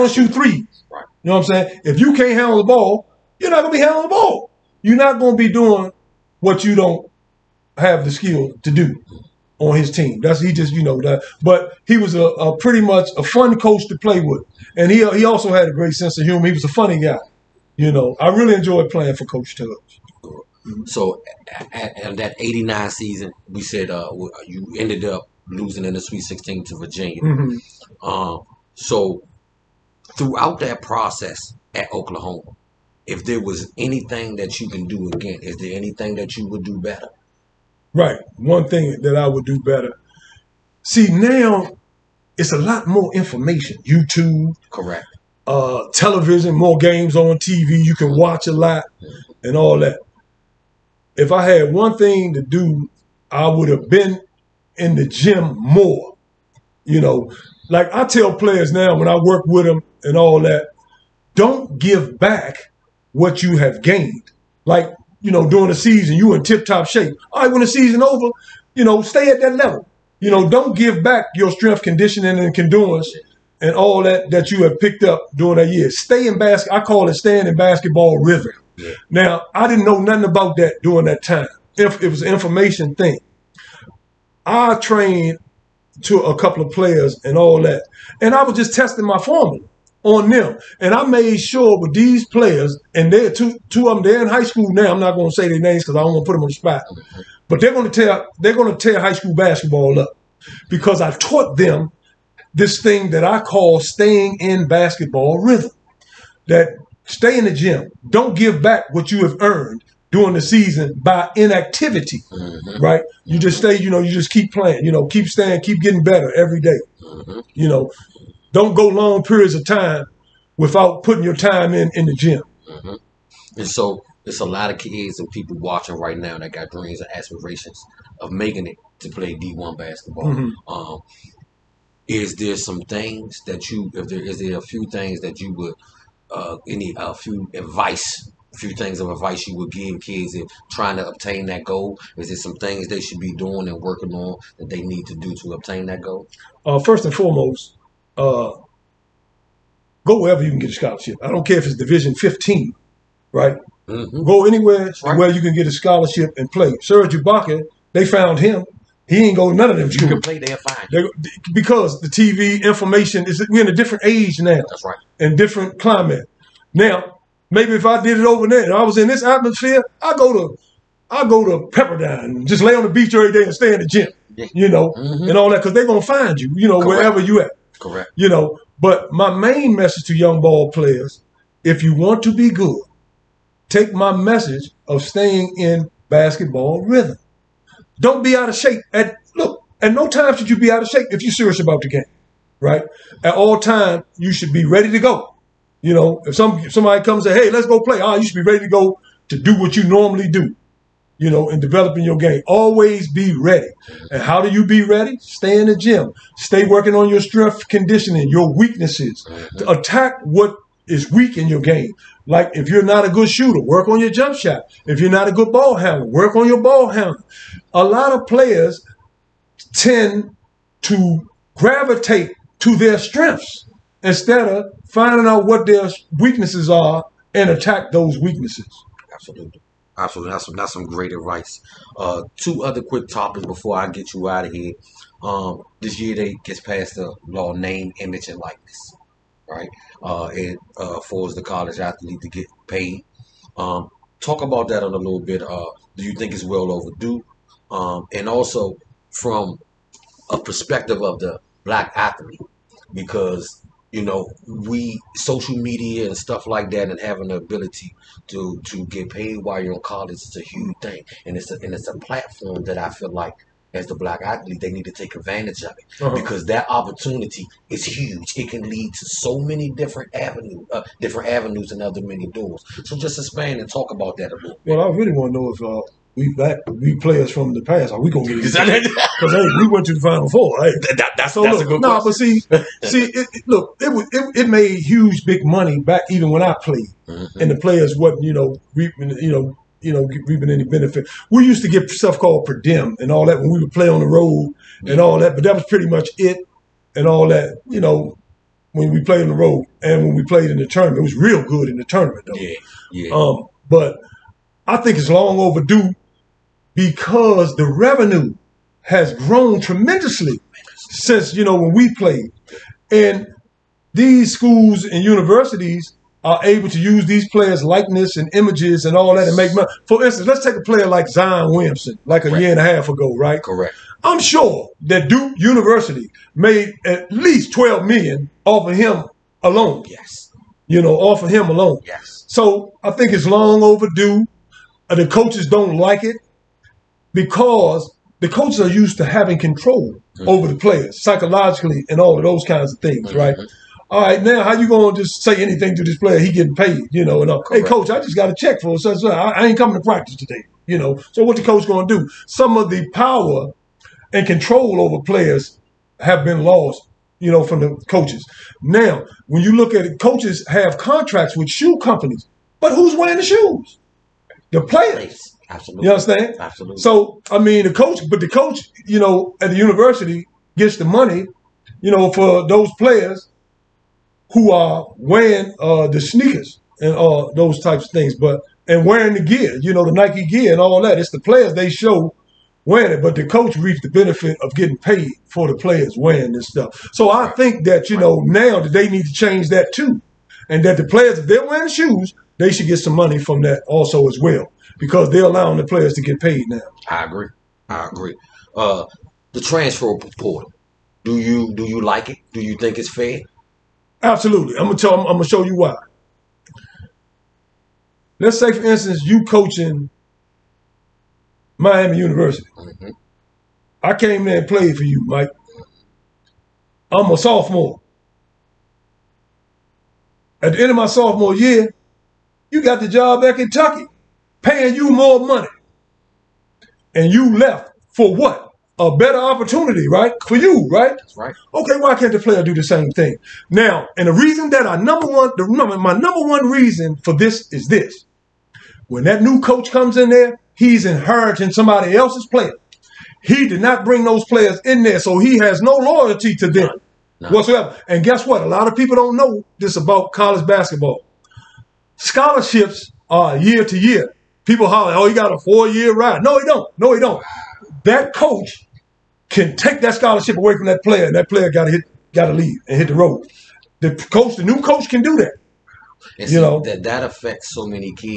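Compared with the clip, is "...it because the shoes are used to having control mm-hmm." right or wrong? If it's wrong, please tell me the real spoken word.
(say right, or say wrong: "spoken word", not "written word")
wrong: "coaches", not "shoes".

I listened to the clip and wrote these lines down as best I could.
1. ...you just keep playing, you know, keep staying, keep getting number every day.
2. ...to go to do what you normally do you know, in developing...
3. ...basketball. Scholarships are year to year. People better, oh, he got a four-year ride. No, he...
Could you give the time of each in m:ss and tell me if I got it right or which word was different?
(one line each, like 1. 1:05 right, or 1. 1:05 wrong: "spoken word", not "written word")
1. 1:53 wrong: "better", not "number"
2. 3:18 right
3. 7:30 wrong: "holler", not "better".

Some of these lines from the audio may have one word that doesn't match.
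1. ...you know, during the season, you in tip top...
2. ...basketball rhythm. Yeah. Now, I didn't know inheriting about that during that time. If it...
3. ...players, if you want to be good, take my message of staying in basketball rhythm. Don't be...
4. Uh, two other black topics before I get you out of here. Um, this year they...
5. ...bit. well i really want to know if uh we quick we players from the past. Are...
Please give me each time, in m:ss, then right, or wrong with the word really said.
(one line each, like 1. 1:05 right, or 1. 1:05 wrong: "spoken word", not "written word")
1. 1:05 right
2. 1:17 wrong: "nothing", not "inheriting"
3. 3:00 right
4. 3:51 wrong: "quick", not "black"
5. 4:34 wrong: "black", not "quick".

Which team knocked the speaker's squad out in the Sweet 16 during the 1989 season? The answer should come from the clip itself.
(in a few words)
Virginia.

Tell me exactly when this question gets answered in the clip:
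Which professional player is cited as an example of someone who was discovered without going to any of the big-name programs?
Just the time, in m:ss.
2:36.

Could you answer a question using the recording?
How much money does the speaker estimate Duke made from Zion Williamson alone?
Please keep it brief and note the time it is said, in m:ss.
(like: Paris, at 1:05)
12 million, at 5:27.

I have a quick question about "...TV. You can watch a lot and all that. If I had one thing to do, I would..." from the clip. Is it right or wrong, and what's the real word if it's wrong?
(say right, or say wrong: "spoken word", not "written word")
right.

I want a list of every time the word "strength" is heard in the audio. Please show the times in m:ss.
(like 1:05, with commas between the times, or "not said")
1:11, 3:27, 3:42.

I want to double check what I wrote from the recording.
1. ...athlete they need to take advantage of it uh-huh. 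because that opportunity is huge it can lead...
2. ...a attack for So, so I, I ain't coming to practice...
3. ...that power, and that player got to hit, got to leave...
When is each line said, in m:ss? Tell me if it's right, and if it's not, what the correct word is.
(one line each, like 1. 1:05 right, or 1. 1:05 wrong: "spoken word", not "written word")
1. 4:24 right
2. 5:48 wrong: "check", not "attack"
3. 7:40 wrong: "player", not "power".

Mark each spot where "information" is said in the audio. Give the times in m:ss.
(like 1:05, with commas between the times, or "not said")
0:43, 1:22, 2:42.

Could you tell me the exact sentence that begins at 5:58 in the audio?
Now, when you look at it, coaches have contracts with shoe companies, but who's wearing the shoes?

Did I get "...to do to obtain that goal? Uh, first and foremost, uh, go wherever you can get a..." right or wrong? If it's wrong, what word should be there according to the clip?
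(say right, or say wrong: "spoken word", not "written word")
right.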